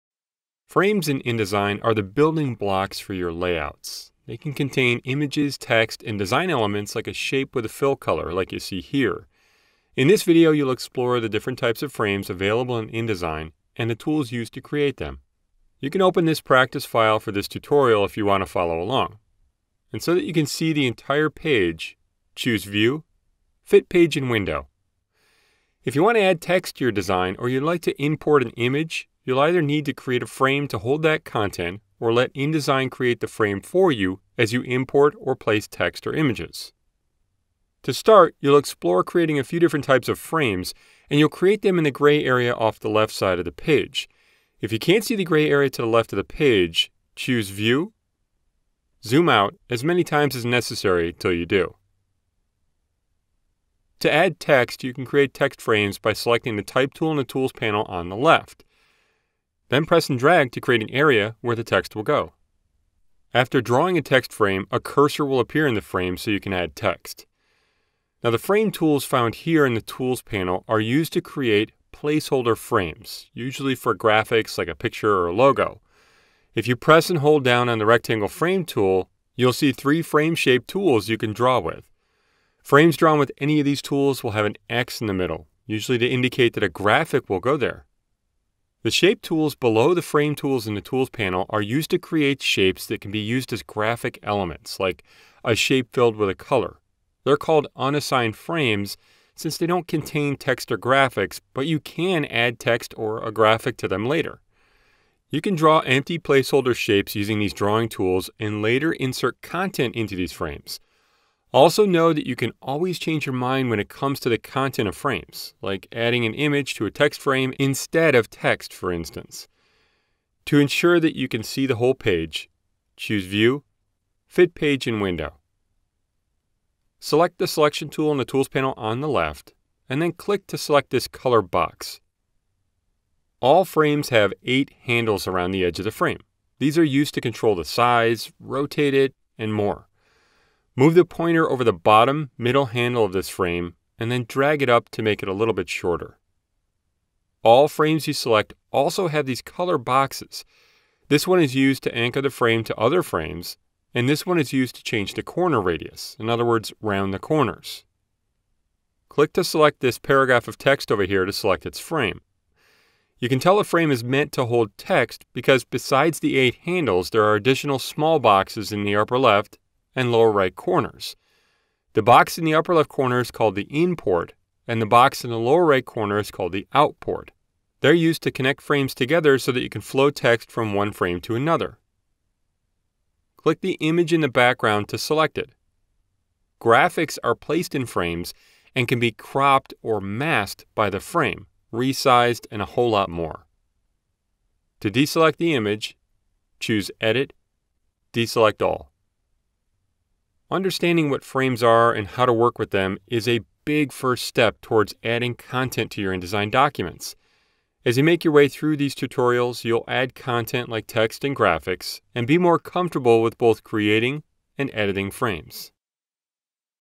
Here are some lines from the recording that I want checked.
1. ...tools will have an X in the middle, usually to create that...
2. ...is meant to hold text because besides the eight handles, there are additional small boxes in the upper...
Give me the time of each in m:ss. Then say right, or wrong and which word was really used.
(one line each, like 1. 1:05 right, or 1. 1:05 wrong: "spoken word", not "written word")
1. 1:23 wrong: "indicate", not "create"
2. 2:43 right.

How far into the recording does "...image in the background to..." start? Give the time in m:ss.
3:03.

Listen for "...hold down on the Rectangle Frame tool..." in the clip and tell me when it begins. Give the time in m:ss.
1:17.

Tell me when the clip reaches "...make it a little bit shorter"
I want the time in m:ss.
2:25.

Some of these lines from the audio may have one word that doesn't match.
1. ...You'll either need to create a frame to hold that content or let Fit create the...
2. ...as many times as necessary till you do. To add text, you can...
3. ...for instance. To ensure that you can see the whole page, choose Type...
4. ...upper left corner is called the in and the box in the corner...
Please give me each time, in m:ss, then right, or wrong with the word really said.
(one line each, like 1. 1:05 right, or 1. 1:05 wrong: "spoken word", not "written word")
1. 0:29 wrong: "InDesign", not "Fit"
2. 0:49 right
3. 1:58 wrong: "View", not "Type"
4. 2:52 wrong: "lower", not "corner".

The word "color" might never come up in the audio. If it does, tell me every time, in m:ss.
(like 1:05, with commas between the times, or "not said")
0:07, 1:36, 2:11, 2:29.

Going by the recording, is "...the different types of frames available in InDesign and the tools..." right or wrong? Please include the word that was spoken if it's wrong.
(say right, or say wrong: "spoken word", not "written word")
right.